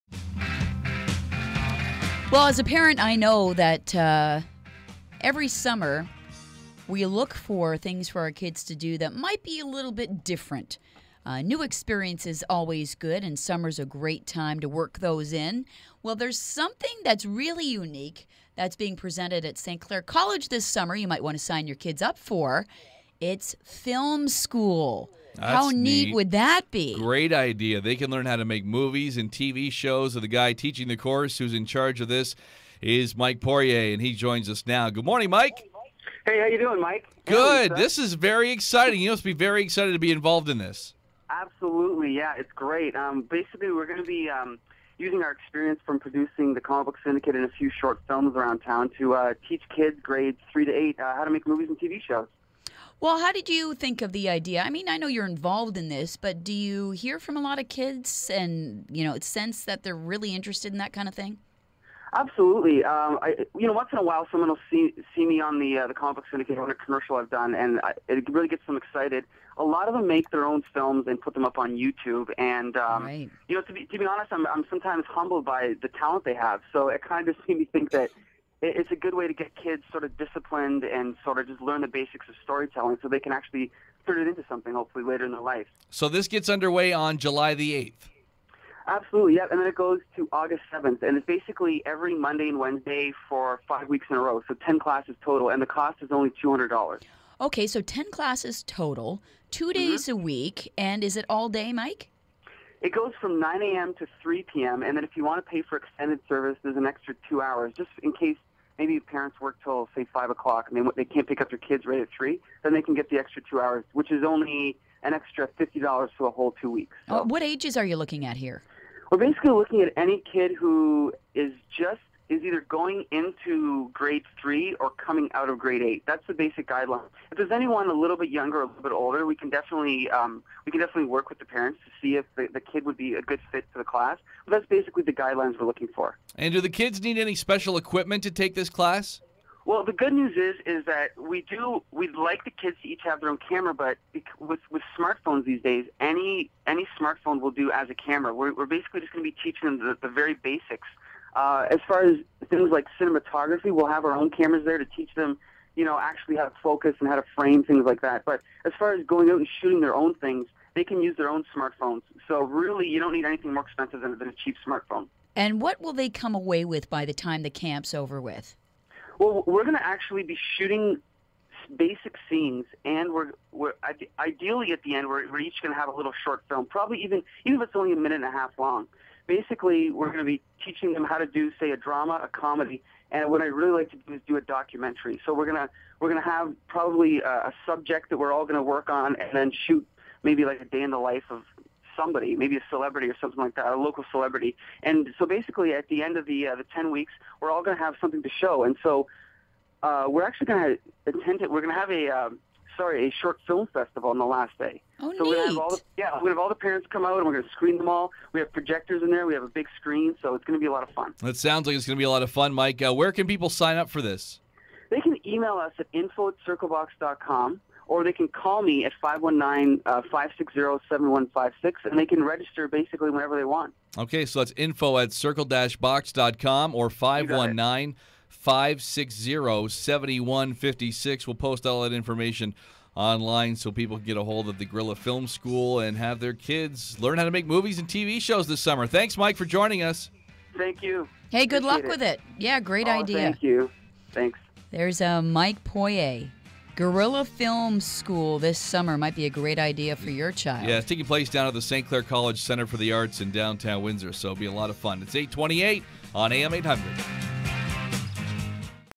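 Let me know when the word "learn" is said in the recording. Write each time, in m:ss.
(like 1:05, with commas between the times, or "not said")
0:28, 1:21, 3:56.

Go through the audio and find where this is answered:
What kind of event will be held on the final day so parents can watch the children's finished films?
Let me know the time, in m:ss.
3:23.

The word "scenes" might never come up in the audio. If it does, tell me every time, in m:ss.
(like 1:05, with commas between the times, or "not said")
2:52.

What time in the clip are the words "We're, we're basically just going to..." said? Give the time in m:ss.
2:28.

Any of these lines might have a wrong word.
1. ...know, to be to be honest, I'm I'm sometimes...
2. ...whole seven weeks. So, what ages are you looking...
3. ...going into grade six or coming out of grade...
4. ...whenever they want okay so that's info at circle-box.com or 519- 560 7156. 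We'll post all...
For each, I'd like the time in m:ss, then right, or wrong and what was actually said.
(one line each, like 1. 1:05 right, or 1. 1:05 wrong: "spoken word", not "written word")
1. 1:13 right
2. 1:56 wrong: "two", not "seven"
3. 2:02 wrong: "three", not "six"
4. 3:43 right.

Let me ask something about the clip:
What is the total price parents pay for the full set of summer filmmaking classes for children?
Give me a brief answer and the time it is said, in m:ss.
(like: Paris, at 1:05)
$200, at 1:36.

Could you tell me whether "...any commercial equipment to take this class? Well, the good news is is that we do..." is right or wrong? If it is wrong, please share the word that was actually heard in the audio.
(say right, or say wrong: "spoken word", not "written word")
wrong: "special", not "commercial".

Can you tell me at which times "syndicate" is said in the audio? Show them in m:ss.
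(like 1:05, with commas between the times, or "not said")
0:47, 1:06.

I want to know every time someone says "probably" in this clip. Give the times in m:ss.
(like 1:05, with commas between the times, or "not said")
2:56, 3:06.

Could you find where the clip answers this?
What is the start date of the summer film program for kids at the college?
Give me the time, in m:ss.
1:27.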